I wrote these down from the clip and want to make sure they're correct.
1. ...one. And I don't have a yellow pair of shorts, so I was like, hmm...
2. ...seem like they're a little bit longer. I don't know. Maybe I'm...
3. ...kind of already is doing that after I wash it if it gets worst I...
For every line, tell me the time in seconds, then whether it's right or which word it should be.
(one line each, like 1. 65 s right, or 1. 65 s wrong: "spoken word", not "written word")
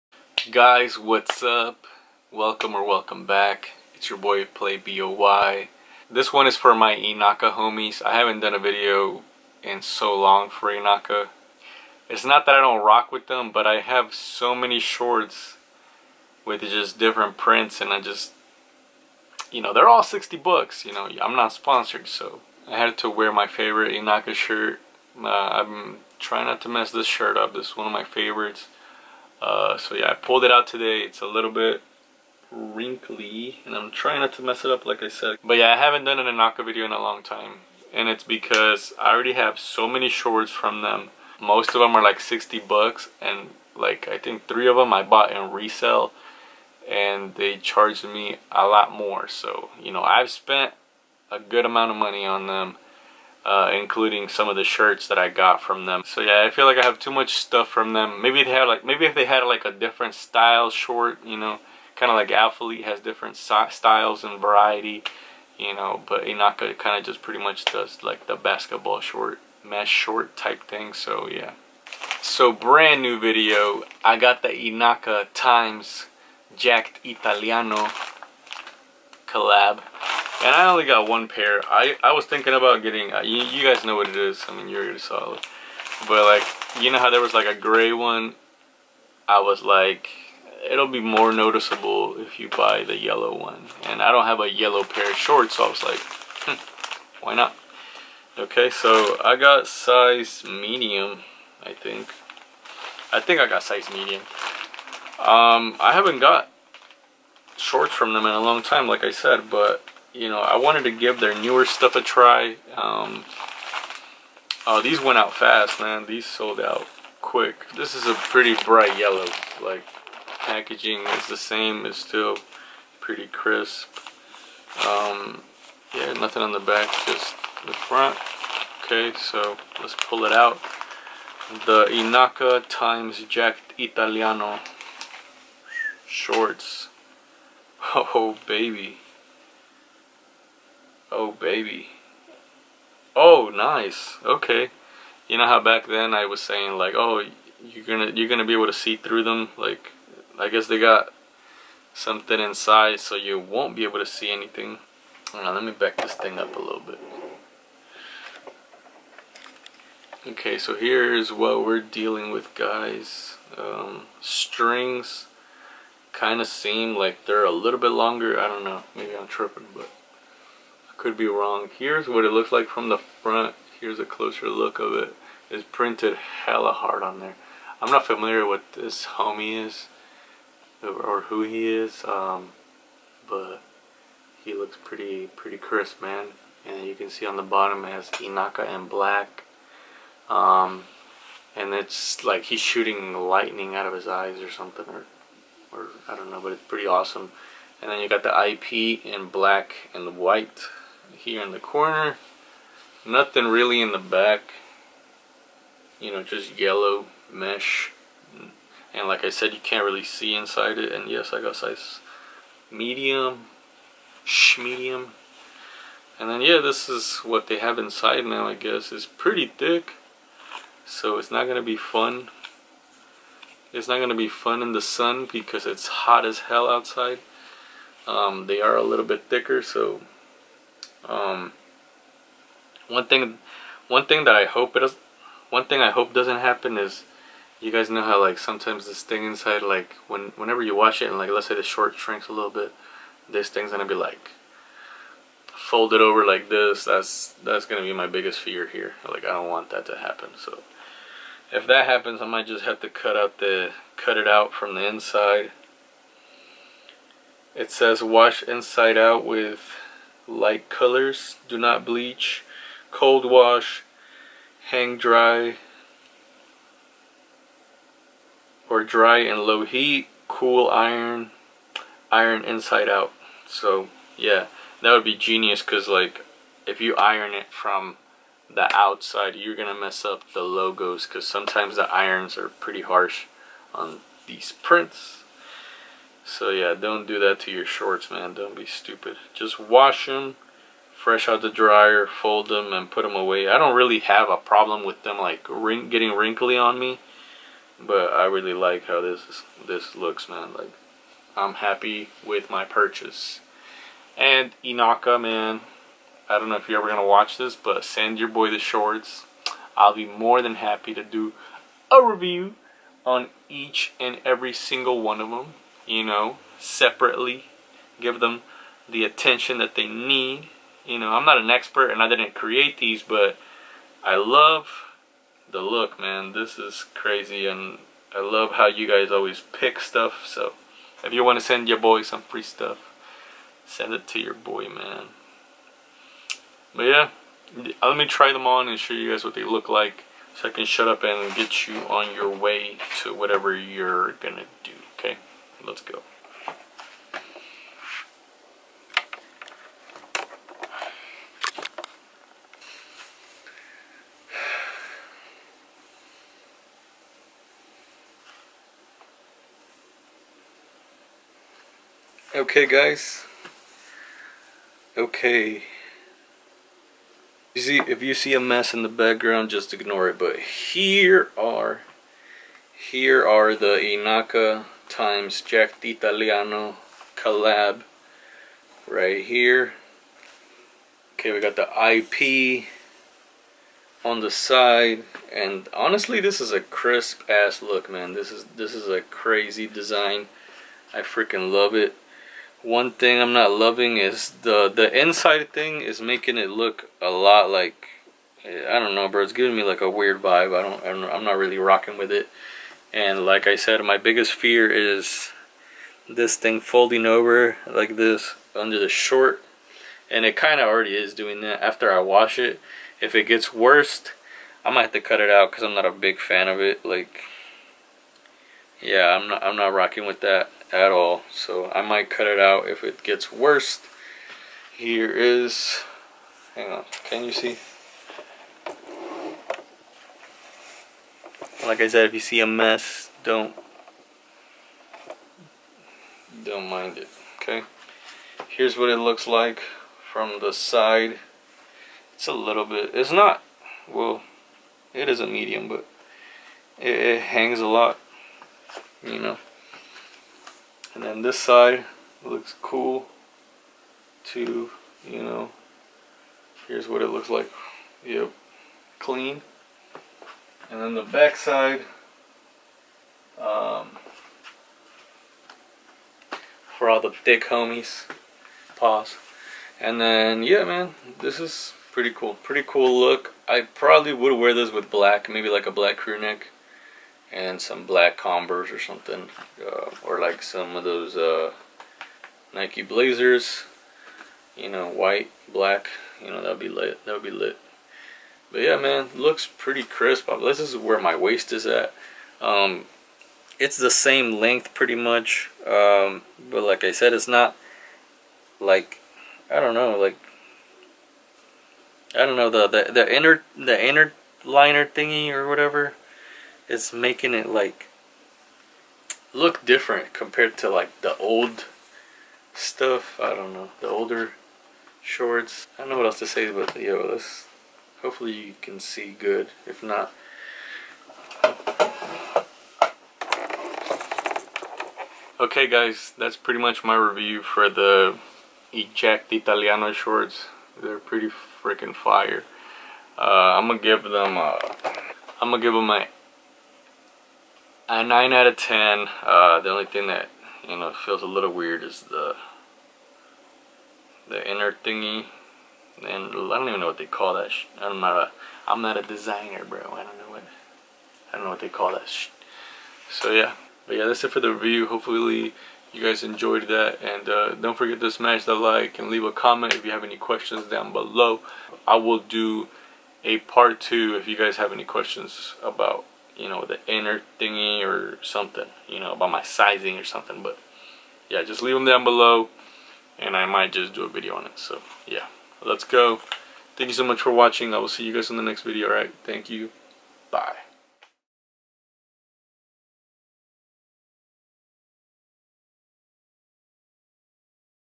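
1. 93 s right
2. 166 s right
3. 410 s right.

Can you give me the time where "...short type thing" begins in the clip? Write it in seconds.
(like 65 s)
69 s.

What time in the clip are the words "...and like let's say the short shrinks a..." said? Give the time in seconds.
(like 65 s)
241 s.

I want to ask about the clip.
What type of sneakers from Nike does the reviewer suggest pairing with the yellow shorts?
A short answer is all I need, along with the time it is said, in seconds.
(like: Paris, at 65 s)
Nike Blazers, at 482 s.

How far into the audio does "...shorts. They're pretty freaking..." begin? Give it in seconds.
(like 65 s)
529 s.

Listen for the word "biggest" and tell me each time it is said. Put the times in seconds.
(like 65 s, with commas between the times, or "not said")
248 s, 403 s.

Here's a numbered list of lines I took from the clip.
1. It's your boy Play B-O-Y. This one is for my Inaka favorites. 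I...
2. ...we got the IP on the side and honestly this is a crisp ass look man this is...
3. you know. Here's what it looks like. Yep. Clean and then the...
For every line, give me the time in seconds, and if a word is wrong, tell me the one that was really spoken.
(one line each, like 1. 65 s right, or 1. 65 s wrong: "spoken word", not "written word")
1. 3 s wrong: "homies", not "favorites"
2. 381 s right
3. 455 s right.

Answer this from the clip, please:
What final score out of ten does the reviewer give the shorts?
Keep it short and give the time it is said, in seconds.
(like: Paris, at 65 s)
9, at 538 s.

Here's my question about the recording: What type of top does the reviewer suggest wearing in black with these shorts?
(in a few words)
Crew neck.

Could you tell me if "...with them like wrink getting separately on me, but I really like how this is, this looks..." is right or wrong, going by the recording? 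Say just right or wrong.
wrong.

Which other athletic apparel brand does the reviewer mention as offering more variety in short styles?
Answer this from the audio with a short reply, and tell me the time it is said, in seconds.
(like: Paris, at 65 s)
Alphalete, at 62 s.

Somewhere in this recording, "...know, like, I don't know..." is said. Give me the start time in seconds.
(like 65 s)
499 s.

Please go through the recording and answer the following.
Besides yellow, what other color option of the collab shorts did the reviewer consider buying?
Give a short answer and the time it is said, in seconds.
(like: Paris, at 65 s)
Gray, at 87 s.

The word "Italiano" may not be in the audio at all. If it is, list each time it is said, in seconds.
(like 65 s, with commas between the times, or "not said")
77 s, 133 s, 375 s, 529 s.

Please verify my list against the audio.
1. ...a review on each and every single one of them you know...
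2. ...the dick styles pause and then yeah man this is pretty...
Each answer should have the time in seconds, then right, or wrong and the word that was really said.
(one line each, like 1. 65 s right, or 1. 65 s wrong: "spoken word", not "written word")
1. 311 s right
2. 467 s wrong: "homies", not "styles".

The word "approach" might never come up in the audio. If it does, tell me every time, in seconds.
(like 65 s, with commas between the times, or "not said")
not said.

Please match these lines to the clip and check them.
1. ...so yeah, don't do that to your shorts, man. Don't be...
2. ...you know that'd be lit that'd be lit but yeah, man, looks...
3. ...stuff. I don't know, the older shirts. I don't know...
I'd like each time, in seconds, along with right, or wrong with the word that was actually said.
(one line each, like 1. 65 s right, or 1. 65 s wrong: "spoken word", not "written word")
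1. 286 s right
2. 486 s right
3. 512 s wrong: "shorts", not "shirts".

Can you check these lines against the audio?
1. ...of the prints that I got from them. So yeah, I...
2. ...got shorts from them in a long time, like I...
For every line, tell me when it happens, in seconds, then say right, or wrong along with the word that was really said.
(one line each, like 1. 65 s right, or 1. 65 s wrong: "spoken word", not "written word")
1. 54 s wrong: "shirts", not "prints"
2. 106 s right.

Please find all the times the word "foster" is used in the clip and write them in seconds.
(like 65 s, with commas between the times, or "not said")
not said.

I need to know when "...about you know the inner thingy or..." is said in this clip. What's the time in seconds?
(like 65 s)
565 s.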